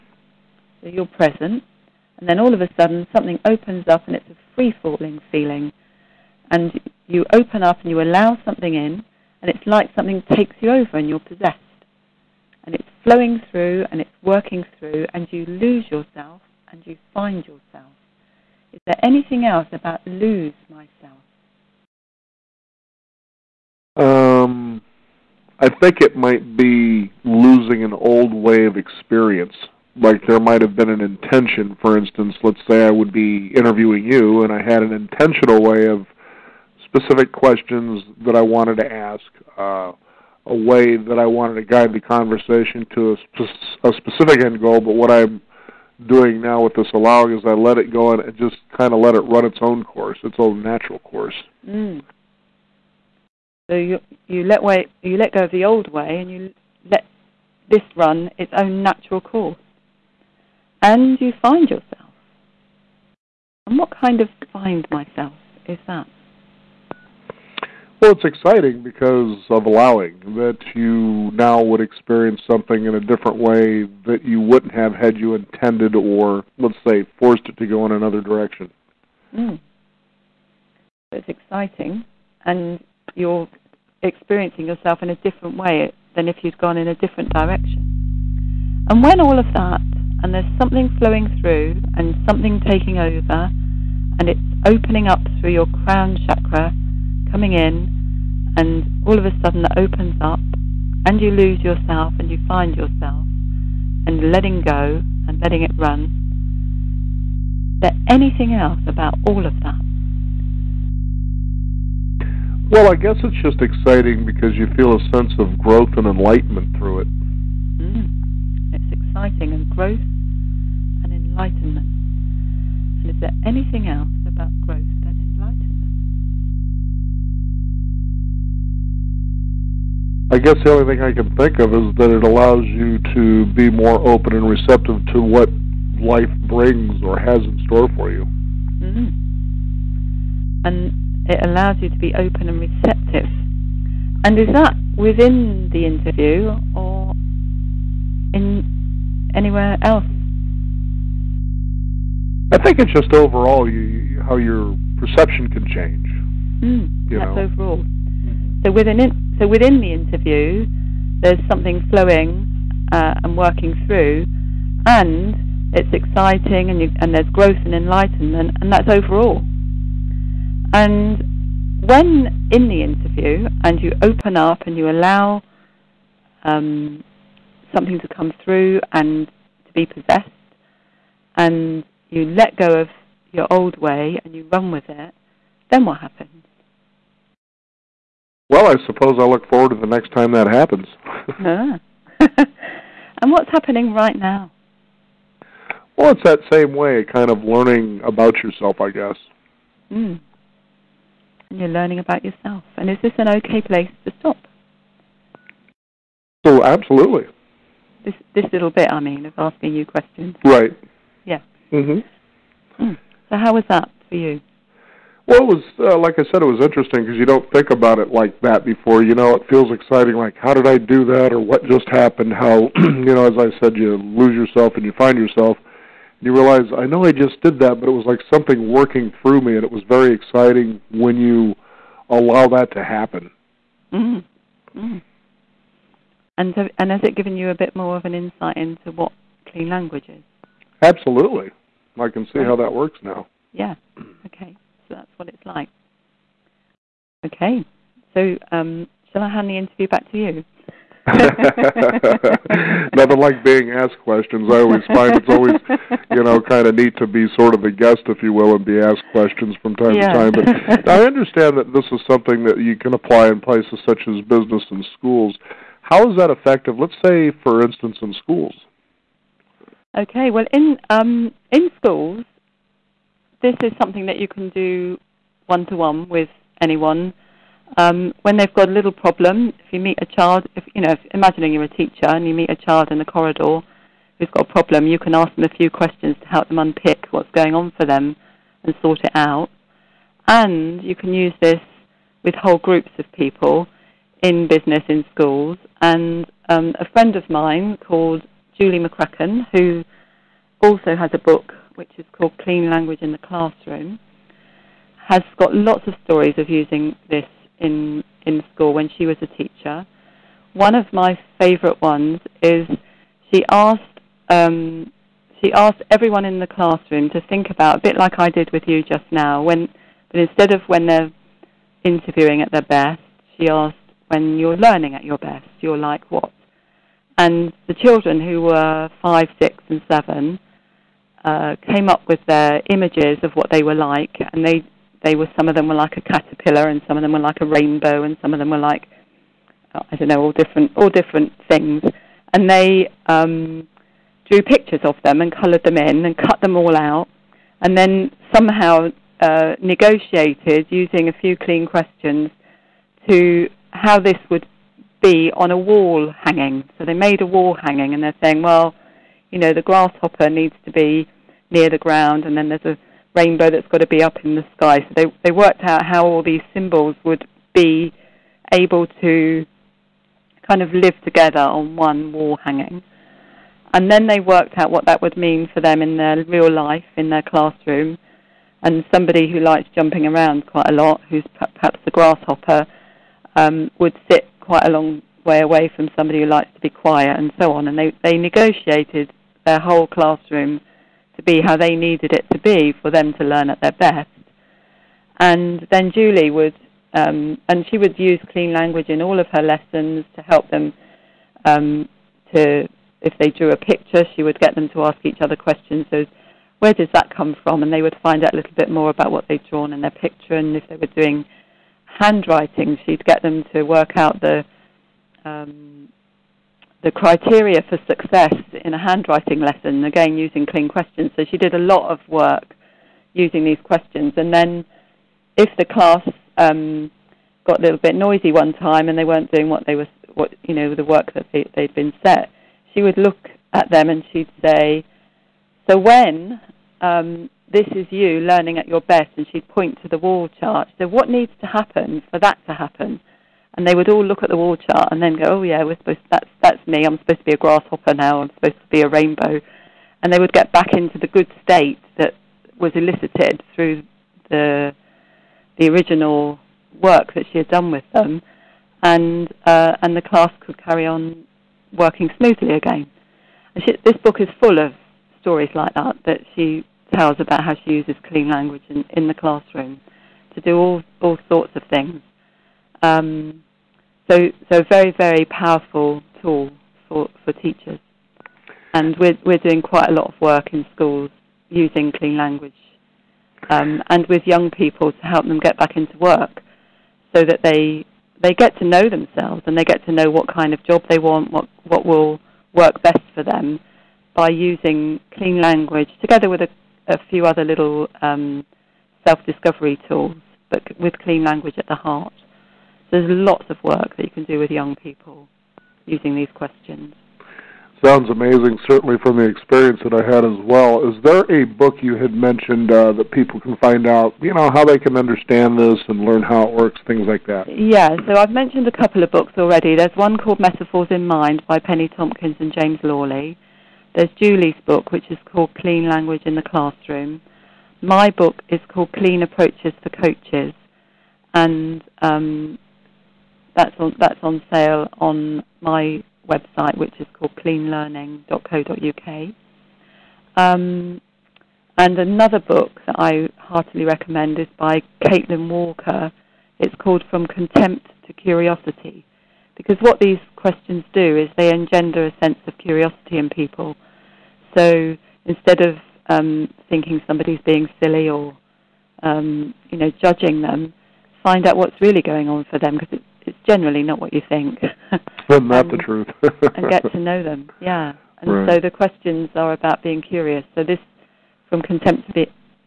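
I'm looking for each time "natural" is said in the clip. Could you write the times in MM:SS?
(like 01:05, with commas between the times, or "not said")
00:50, 00:58.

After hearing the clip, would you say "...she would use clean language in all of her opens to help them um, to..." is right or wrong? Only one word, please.
wrong.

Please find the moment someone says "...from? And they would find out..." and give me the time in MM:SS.
06:47.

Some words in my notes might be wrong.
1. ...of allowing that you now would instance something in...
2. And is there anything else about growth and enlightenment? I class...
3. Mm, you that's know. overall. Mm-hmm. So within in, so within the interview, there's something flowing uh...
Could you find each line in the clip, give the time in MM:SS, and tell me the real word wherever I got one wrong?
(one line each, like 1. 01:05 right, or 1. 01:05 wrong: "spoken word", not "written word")
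1. 01:09 wrong: "experience", not "instance"
2. 02:03 wrong: "guess", not "class"
3. 02:36 right.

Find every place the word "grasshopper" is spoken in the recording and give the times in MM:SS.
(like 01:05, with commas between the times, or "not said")
05:59, 06:21, 07:27.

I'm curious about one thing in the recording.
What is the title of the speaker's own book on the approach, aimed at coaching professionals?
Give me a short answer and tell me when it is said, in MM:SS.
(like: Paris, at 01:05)
Clean Approaches for Coaches, at 08:48.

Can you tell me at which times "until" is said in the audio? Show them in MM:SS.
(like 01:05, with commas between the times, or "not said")
not said.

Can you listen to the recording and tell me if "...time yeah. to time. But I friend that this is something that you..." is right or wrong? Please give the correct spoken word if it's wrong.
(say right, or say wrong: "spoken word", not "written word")
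wrong: "understand", not "friend".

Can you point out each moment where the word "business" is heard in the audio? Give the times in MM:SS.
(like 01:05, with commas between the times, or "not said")
04:24, 04:54.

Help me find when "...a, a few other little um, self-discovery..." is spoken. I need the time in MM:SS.
08:16.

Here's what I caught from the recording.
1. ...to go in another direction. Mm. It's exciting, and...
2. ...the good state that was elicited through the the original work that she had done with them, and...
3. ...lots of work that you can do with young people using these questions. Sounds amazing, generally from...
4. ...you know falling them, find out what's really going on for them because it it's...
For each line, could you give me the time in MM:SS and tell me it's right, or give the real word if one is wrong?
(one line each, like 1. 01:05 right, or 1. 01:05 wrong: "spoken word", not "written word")
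1. 01:17 right
2. 07:30 right
3. 08:23 wrong: "certainly", not "generally"
4. 09:19 wrong: "judging", not "falling".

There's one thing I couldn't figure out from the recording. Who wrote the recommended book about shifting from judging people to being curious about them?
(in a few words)
Caitlin Walker.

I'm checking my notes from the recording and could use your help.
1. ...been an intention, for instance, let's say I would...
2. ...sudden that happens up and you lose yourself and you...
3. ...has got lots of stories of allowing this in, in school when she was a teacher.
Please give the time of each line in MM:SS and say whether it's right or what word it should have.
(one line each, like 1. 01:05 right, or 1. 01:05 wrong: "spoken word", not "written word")
1. 00:30 right
2. 01:39 wrong: "opens", not "happens"
3. 05:05 wrong: "using", not "allowing".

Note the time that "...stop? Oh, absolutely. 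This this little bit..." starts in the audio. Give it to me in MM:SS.
03:24.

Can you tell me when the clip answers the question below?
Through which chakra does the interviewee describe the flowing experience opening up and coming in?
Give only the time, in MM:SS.
01:35.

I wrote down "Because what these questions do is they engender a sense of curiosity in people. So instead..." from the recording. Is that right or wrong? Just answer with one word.
right.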